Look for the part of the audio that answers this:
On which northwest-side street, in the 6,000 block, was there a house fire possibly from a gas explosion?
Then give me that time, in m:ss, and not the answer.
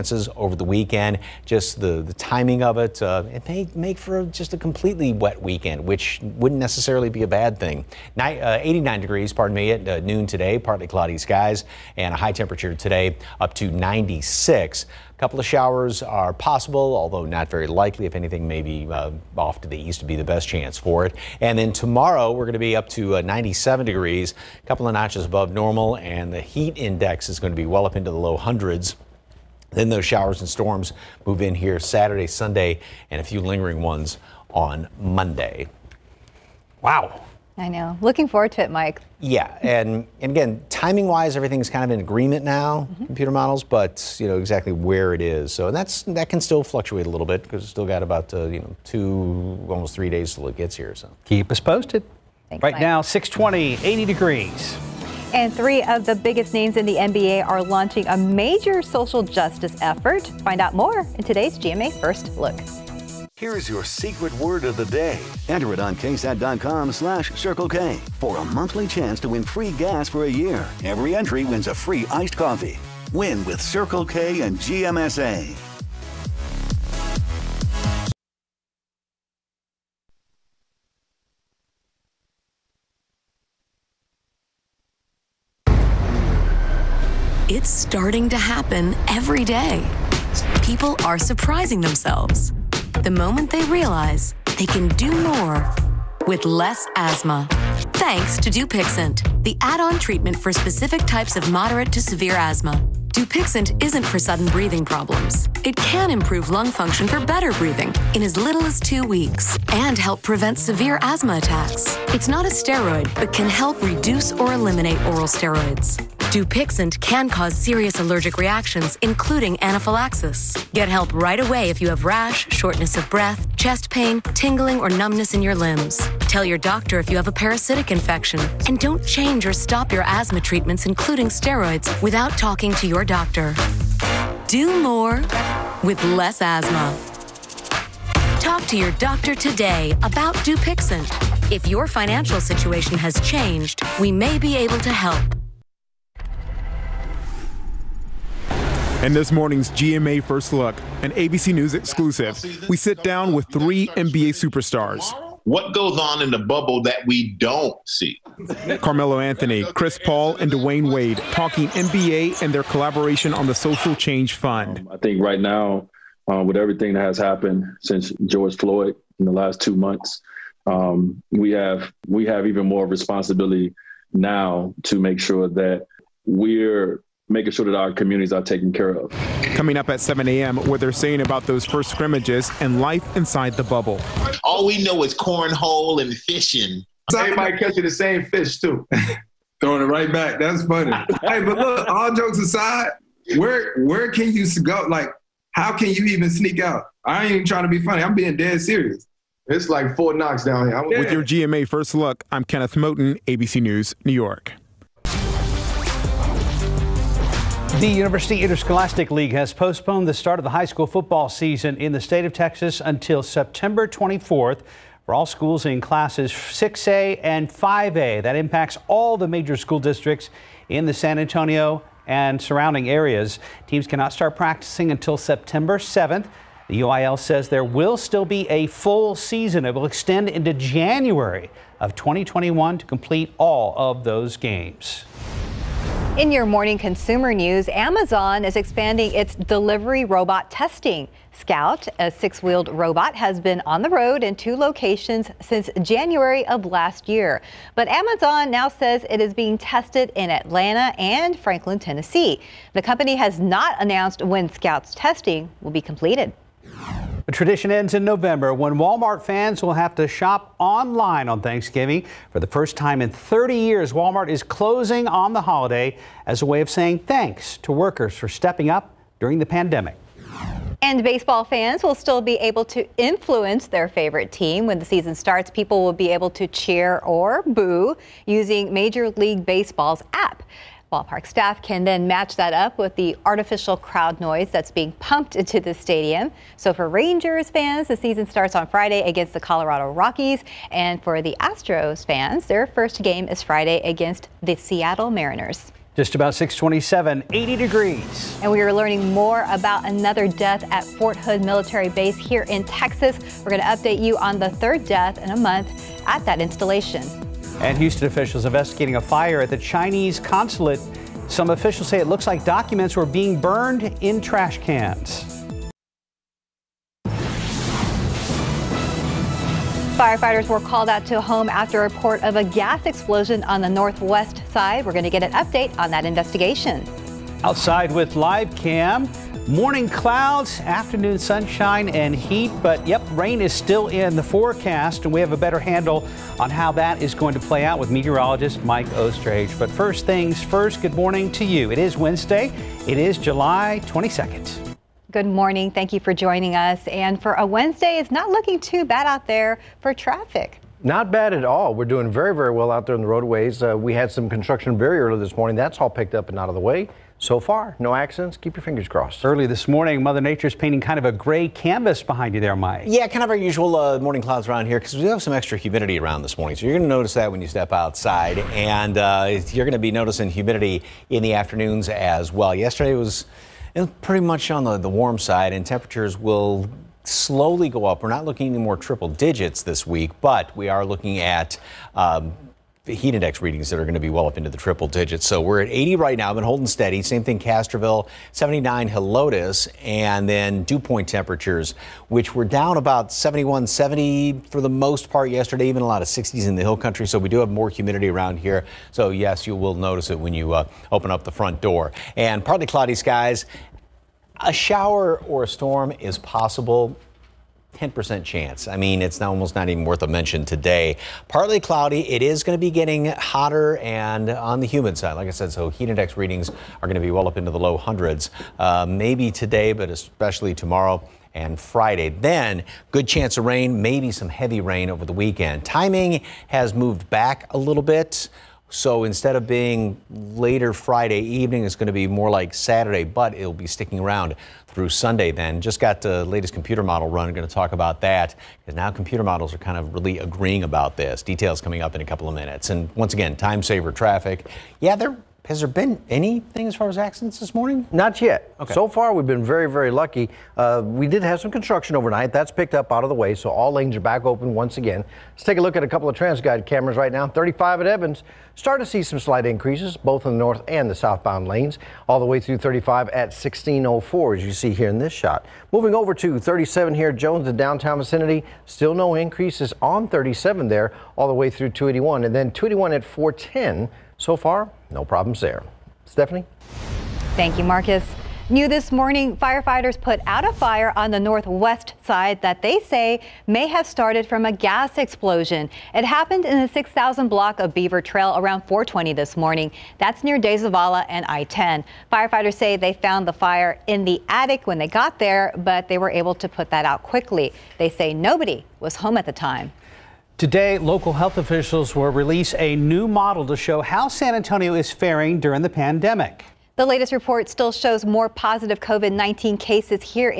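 8:07.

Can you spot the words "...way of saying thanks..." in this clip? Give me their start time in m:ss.
4:26.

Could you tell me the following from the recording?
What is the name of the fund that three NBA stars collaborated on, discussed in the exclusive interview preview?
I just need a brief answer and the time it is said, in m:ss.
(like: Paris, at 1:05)
Social Change Fund, at 2:43.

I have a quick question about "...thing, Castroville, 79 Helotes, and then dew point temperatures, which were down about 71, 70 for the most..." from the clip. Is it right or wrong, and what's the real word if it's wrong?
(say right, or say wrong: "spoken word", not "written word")
right.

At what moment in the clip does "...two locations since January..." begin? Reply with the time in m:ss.
4:04.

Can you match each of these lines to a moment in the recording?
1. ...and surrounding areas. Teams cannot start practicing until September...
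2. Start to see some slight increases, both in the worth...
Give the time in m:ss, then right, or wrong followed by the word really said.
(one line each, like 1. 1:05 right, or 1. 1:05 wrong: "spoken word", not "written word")
1. 3:42 right
2. 7:38 wrong: "north", not "worth".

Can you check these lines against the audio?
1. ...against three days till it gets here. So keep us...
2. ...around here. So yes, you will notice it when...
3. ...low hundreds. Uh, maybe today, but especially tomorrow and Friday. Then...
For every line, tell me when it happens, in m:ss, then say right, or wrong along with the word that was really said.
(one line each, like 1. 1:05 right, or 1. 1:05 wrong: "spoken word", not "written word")
1. 0:49 wrong: "almost", not "against"
2. 6:38 right
3. 6:57 right.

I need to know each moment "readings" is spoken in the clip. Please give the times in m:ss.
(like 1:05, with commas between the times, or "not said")
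6:23, 6:56.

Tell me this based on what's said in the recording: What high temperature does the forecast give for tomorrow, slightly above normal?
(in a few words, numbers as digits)
97 degrees.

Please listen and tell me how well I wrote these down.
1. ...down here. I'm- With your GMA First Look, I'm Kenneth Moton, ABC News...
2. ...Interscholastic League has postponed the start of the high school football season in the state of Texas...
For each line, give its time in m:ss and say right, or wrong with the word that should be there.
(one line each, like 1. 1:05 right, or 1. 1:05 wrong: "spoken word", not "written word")
1. 3:20 right
2. 3:28 right.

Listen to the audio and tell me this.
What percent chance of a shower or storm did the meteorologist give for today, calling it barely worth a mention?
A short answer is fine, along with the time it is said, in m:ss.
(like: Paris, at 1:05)
10%, at 6:47.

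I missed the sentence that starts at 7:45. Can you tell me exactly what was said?
Moving over to 37 here, Jones, the downtown vicinity.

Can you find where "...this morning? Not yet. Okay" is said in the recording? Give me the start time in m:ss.
7:27.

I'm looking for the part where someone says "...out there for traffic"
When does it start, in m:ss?
5:49.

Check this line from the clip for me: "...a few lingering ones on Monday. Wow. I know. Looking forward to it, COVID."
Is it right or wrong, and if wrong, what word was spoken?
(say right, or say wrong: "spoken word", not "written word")
wrong: "Mike", not "COVID".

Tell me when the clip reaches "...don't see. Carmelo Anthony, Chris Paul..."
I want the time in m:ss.
2:37.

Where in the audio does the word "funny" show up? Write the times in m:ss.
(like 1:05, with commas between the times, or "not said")
3:10, 3:17.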